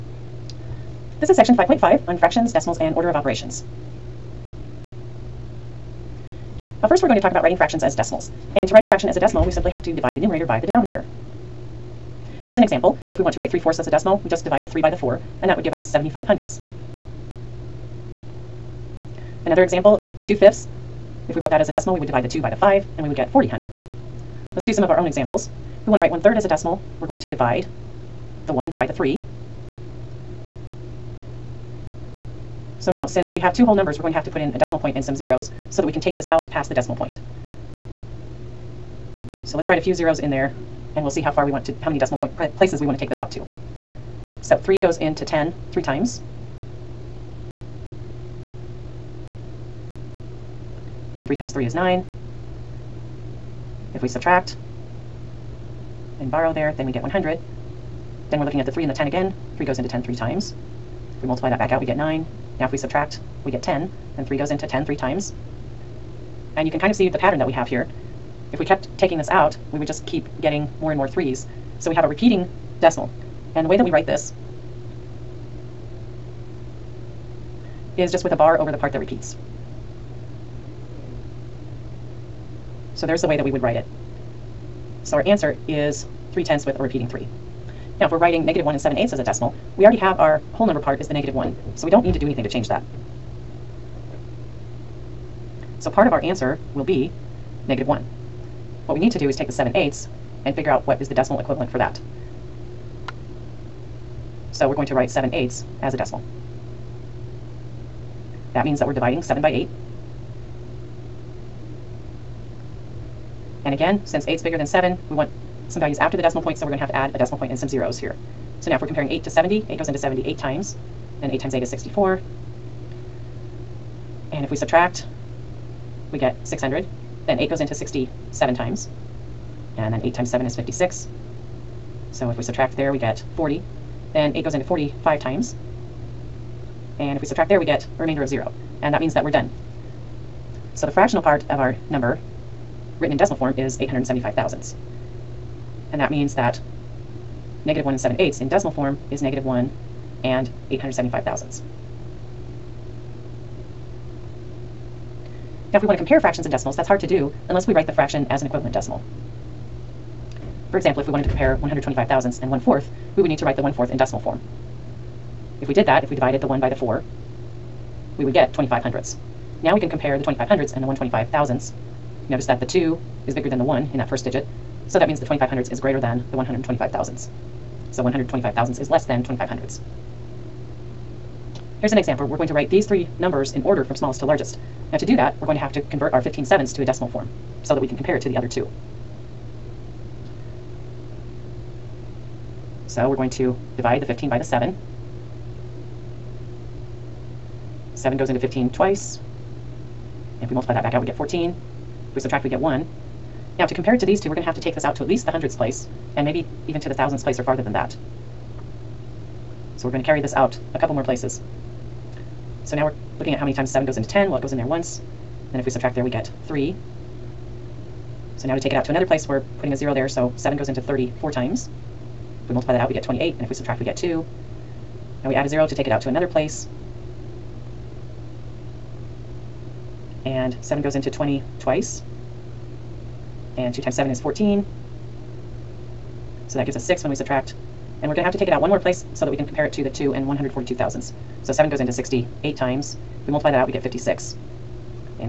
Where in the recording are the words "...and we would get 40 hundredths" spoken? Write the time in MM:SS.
00:22.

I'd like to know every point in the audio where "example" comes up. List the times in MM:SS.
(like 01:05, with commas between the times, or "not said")
00:12, 00:19, 00:25, 02:40, 03:01.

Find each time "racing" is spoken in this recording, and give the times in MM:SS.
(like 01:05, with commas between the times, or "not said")
not said.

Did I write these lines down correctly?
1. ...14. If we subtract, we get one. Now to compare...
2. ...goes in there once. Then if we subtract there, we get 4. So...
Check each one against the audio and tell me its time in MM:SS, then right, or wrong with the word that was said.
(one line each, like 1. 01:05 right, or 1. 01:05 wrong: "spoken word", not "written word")
1. 03:21 right
2. 03:34 wrong: "3", not "4".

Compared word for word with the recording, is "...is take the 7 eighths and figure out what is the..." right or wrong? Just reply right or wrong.
right.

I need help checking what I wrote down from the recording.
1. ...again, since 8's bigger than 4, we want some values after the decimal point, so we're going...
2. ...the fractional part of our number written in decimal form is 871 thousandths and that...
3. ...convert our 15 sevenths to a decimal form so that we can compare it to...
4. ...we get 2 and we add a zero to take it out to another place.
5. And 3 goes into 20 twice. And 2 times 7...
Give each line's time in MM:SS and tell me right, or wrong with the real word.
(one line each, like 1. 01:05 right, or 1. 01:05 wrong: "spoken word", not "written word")
1. 01:53 wrong: "7", not "4"
2. 02:20 wrong: "875", not "871"
3. 03:05 right
4. 03:43 right
5. 03:50 wrong: "7", not "3".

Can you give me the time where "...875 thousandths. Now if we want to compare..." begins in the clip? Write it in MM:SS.
02:30.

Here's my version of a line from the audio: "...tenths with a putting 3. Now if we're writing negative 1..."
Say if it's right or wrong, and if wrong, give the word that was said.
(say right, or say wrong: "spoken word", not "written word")
wrong: "repeating", not "putting".